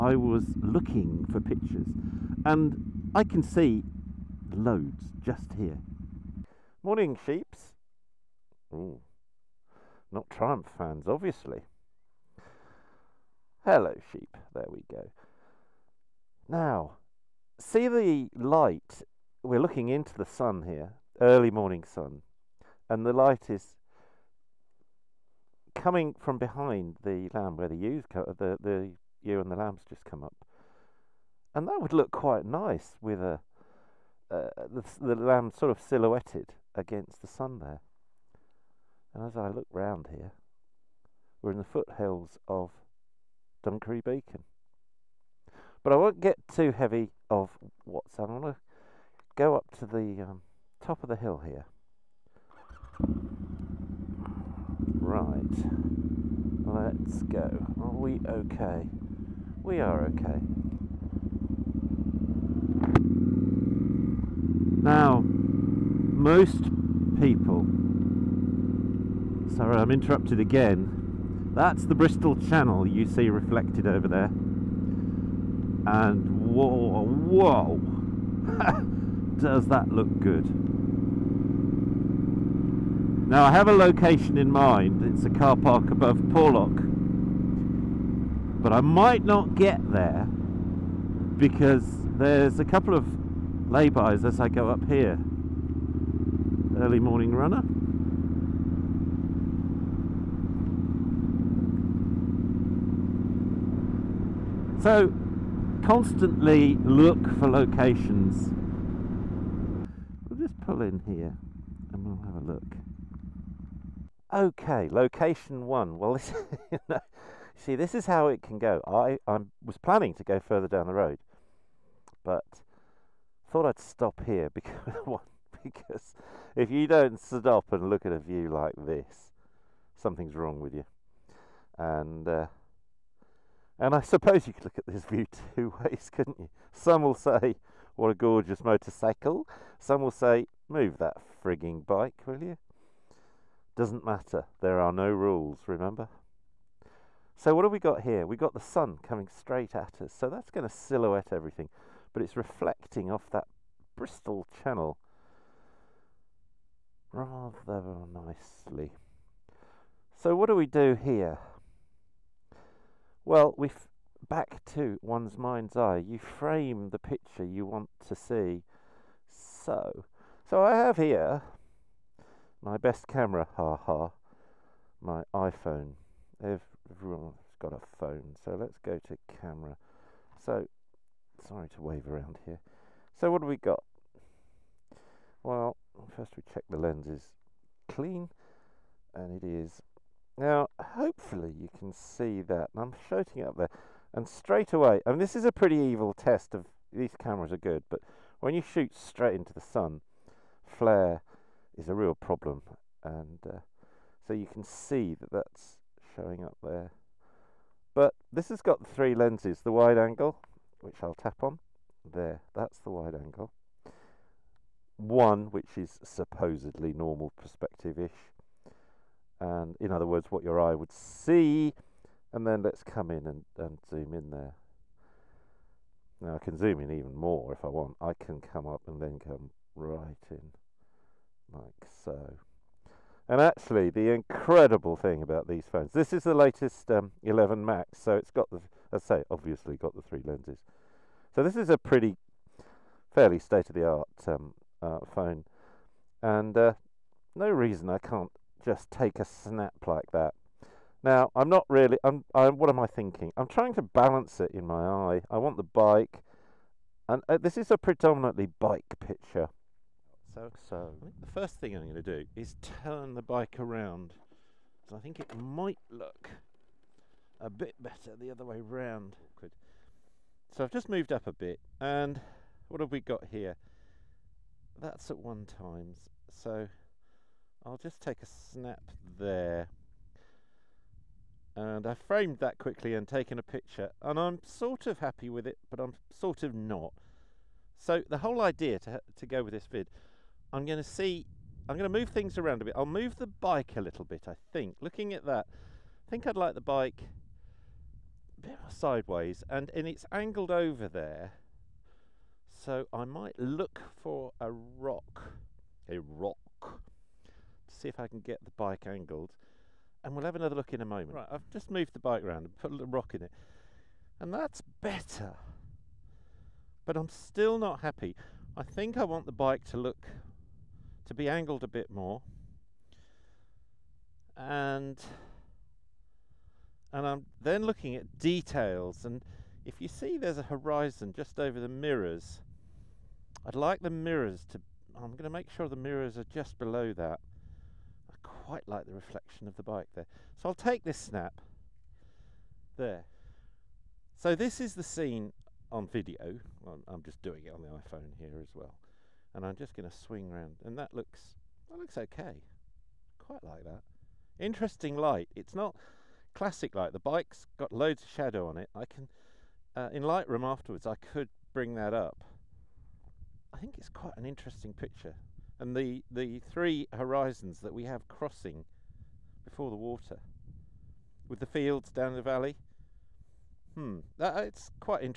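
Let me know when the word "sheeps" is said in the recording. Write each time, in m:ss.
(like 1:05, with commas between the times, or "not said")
0:07, 0:14.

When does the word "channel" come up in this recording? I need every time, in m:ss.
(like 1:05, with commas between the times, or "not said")
1:12, 2:34.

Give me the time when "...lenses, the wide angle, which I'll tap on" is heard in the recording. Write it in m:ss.
3:29.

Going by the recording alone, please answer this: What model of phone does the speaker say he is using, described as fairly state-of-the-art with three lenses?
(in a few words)
11 Max.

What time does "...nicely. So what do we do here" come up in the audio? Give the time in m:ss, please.
2:38.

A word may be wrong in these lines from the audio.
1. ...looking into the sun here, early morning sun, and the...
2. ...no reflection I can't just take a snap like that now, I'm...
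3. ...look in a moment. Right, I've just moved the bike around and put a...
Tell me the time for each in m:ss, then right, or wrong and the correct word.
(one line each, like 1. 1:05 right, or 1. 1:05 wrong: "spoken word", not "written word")
1. 0:19 right
2. 4:07 wrong: "reason", not "reflection"
3. 5:10 right.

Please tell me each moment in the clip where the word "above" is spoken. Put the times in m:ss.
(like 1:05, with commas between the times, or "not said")
1:25.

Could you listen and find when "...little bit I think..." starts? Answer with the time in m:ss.
4:53.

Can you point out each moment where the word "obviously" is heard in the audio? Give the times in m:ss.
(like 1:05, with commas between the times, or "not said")
0:11, 3:59.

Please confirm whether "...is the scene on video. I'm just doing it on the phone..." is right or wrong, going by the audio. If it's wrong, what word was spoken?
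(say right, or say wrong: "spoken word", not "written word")
wrong: "iPhone", not "phone".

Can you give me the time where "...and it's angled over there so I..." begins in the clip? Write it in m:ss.
4:59.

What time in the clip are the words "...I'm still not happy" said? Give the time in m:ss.
5:16.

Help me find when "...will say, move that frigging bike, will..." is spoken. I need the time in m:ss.
2:20.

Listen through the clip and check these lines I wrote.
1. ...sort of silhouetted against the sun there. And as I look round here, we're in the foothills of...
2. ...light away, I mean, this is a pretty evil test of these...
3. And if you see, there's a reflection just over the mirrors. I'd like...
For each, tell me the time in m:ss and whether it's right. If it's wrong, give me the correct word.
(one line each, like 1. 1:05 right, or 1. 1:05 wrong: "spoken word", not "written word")
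1. 0:35 right
2. 3:14 wrong: "straight", not "light"
3. 5:29 wrong: "horizon", not "reflection".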